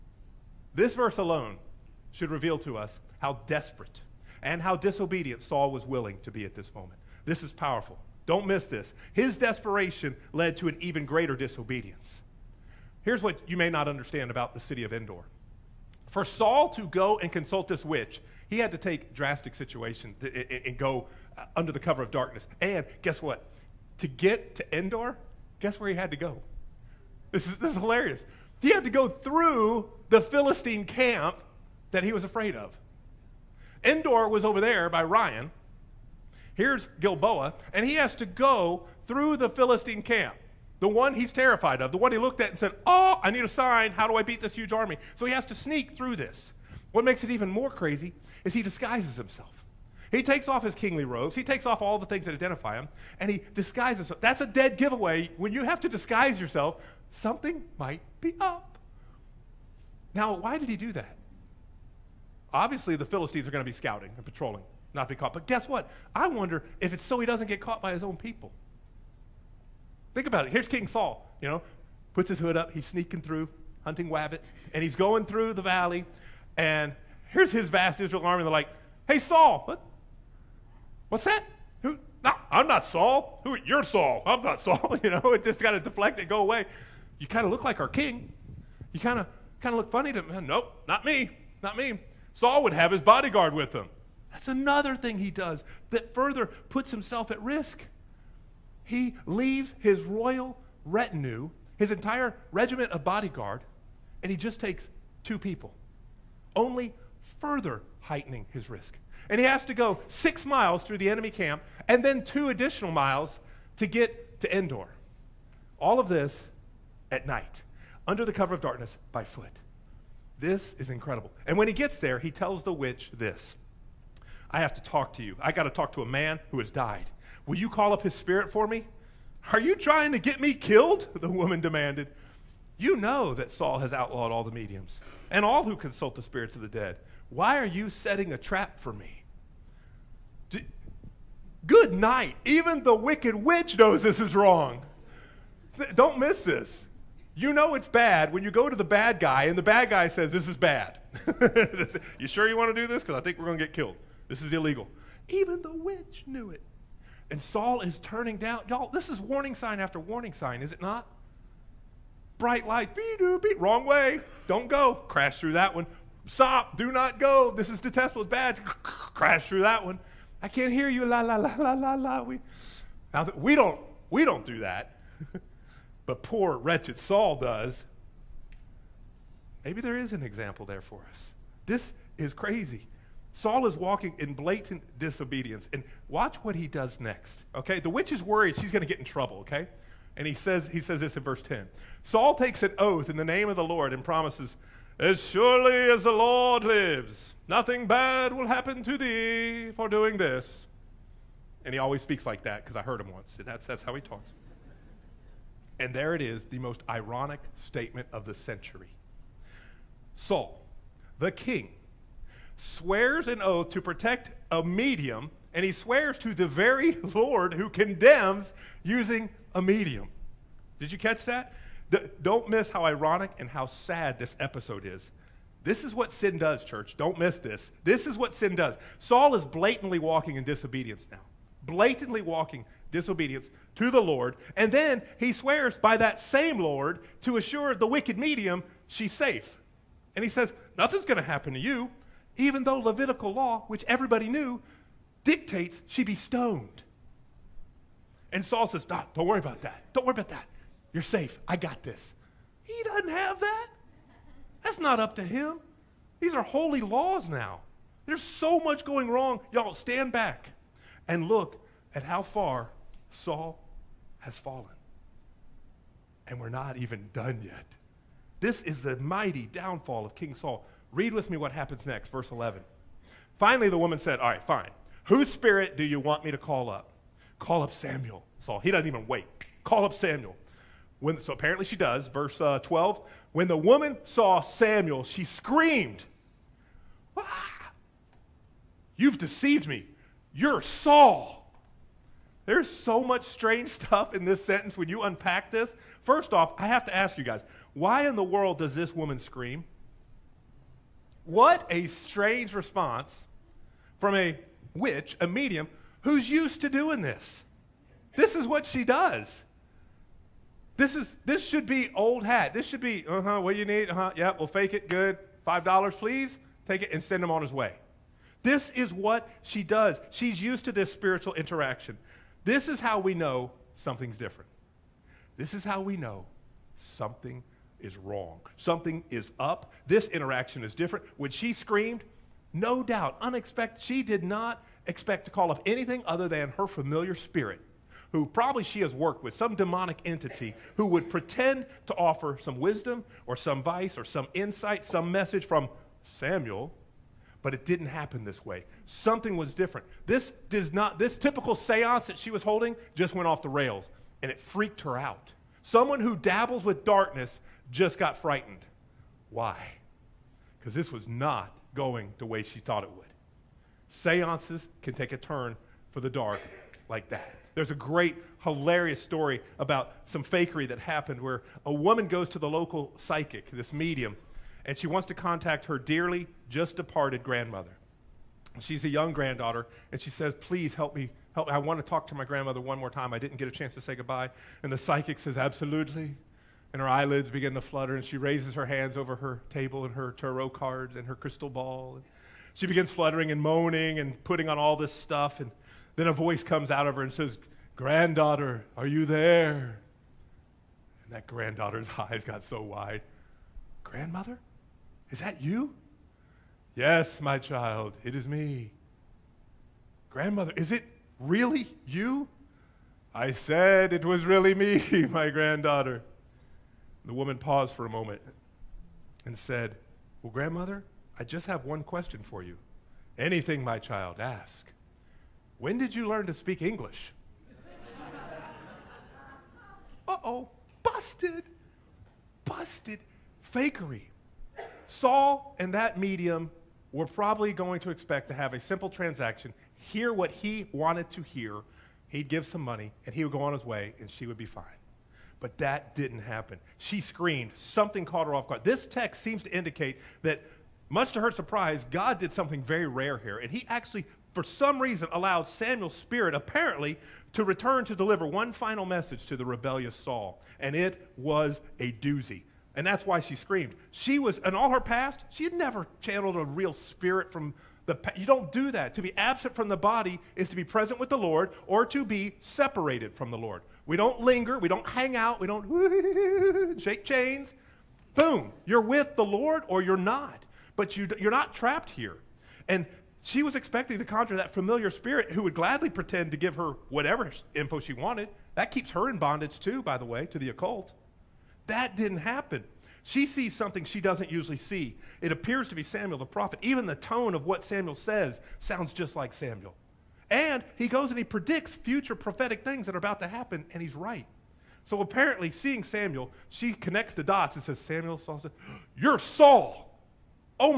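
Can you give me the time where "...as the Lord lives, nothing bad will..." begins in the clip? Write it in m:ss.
3:15.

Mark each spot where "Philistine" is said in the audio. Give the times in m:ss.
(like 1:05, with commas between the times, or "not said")
0:30, 0:39, 1:03.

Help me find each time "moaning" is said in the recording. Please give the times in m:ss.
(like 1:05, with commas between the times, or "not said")
6:33.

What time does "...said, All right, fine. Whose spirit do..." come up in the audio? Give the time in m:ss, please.
4:33.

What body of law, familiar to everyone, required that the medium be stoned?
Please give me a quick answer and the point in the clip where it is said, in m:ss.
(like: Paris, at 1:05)
Levitical law, at 4:02.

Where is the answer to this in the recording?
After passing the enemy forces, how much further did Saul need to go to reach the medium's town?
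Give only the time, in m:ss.
1:52.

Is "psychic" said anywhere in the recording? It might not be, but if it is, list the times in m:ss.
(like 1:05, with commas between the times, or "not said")
6:12, 6:24.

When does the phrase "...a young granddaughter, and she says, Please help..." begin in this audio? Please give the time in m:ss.
6:18.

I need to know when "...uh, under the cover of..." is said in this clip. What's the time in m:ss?
0:21.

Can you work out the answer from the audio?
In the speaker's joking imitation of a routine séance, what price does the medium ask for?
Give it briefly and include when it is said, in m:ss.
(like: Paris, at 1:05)
$5, at 5:15.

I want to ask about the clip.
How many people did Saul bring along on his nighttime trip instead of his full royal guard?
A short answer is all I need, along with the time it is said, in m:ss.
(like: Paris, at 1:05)
2, at 1:45.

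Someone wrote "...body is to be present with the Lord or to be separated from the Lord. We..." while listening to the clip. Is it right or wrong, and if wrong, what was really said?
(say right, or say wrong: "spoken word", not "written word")
right.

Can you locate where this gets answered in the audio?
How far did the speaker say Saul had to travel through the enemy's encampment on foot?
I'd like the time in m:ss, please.
1:50.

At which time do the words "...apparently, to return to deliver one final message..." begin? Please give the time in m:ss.
7:36.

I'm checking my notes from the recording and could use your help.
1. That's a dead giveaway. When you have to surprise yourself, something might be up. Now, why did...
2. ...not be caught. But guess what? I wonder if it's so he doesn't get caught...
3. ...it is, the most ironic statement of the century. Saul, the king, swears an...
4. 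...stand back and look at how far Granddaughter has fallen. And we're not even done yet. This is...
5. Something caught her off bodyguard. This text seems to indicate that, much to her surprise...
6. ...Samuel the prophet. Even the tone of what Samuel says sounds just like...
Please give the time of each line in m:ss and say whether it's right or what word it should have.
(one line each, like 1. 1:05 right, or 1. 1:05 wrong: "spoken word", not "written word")
1. 0:54 wrong: "disguise", not "surprise"
2. 1:04 right
3. 3:26 right
4. 4:19 wrong: "Saul", not "Granddaughter"
5. 7:27 wrong: "guard", not "bodyguard"
6. 8:15 right.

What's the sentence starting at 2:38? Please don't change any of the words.
Y'all, this is warning sign after warning sign, is it not?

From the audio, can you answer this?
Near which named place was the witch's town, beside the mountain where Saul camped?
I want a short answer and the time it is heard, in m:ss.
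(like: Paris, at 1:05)
Ryan, at 0:35.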